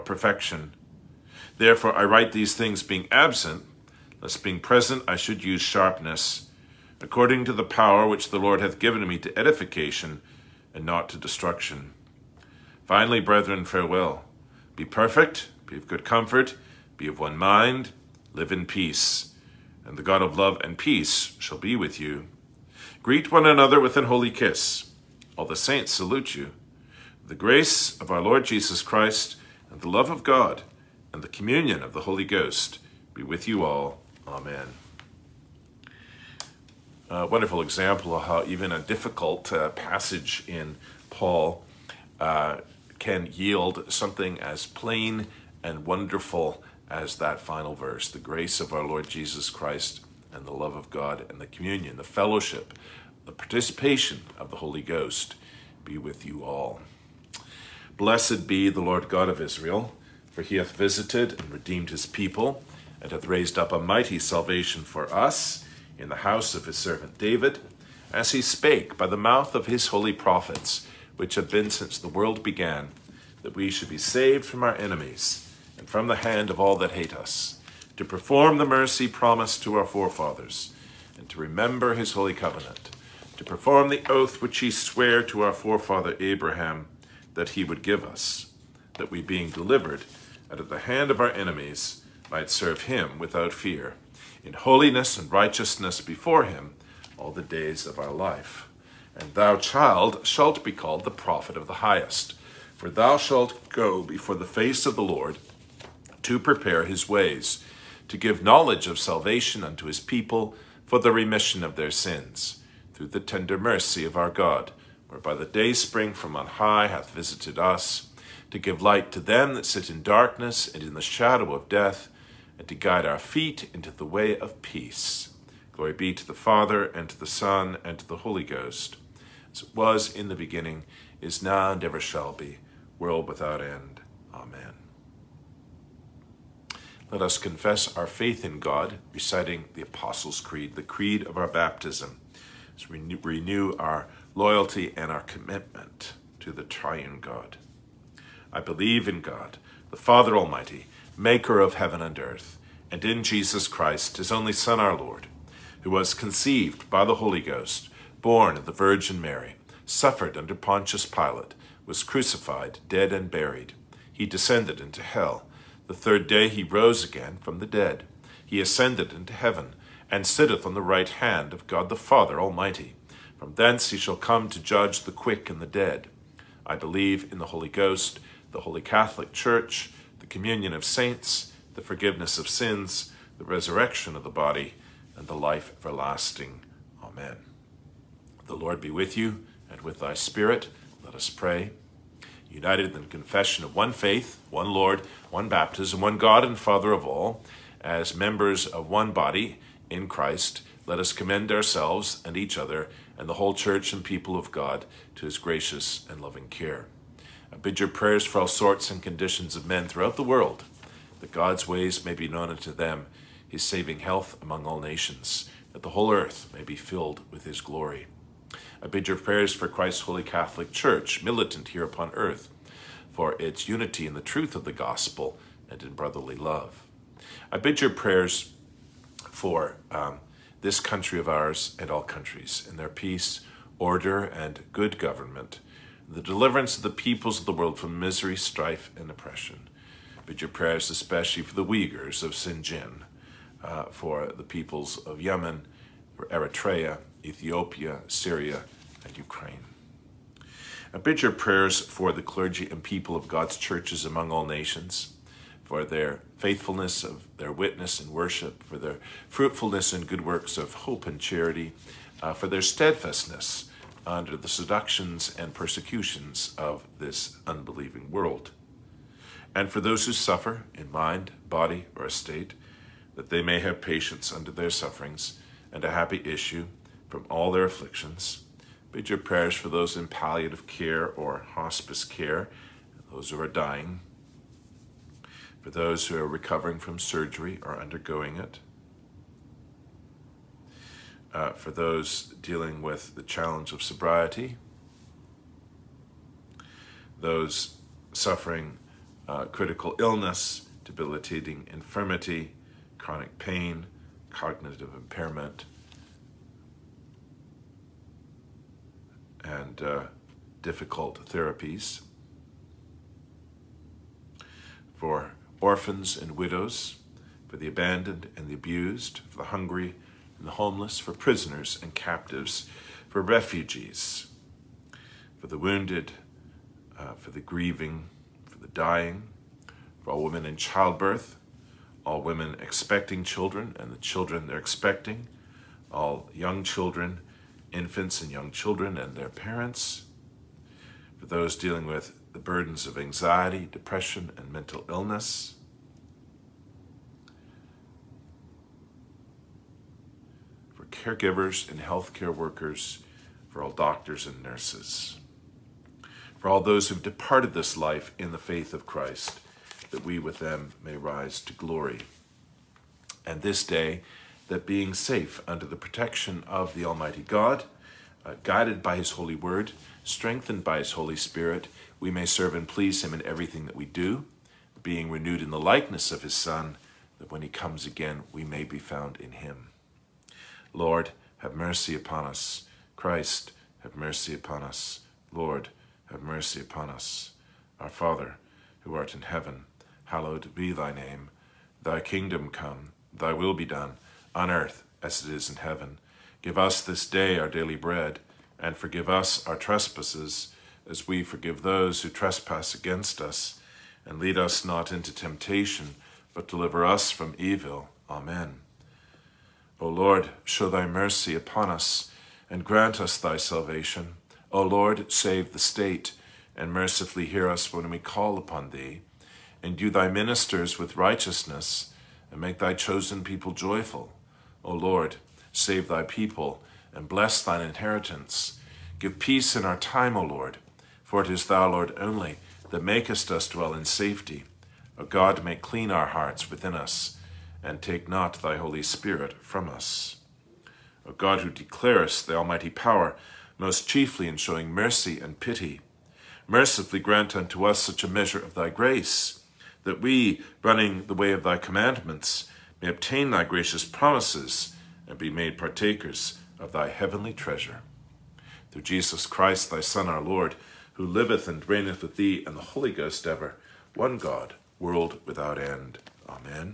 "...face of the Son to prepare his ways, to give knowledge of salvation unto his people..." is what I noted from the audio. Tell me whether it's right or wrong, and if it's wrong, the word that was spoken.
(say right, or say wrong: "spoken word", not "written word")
wrong: "Lord", not "Son".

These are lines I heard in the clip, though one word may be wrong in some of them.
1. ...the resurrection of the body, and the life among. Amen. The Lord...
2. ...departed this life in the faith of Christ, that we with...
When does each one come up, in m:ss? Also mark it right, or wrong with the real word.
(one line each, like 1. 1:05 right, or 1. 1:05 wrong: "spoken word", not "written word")
1. 3:03 wrong: "everlasting", not "among"
2. 5:57 right.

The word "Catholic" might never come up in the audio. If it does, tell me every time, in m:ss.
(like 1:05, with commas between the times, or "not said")
2:58, 3:40.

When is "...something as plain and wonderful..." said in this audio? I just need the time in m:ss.
0:43.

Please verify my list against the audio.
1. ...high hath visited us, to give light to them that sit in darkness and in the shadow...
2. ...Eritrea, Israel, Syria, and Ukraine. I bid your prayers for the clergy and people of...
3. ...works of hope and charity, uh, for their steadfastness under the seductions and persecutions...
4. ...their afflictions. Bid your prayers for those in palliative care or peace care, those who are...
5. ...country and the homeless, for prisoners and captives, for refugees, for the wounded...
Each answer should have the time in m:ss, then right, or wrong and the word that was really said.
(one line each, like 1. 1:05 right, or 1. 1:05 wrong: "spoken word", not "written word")
1. 1:56 right
2. 4:06 wrong: "Ethiopia", not "Israel"
3. 4:20 right
4. 4:37 wrong: "hospice", not "peace"
5. 5:19 wrong: "hungry", not "country".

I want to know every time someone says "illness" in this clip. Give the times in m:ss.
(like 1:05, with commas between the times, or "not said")
4:59, 5:44.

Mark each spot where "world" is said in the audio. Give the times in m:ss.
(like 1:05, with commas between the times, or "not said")
1:12, 2:12, 3:30, 3:57, 4:28, 7:44.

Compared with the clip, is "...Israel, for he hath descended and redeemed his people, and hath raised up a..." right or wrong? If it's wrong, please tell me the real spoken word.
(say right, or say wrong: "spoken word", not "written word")
wrong: "visited", not "descended".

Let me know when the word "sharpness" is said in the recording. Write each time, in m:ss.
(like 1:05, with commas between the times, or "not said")
0:05.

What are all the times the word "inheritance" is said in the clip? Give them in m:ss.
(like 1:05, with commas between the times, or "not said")
7:07.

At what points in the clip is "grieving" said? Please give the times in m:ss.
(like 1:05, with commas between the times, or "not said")
5:27.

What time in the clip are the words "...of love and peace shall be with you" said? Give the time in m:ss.
0:20.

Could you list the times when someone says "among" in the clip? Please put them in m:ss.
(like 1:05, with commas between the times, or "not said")
3:34, 4:14.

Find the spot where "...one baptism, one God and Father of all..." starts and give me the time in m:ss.
3:15.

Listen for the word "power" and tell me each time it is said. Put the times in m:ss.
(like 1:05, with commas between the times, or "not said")
0:07, 7:22.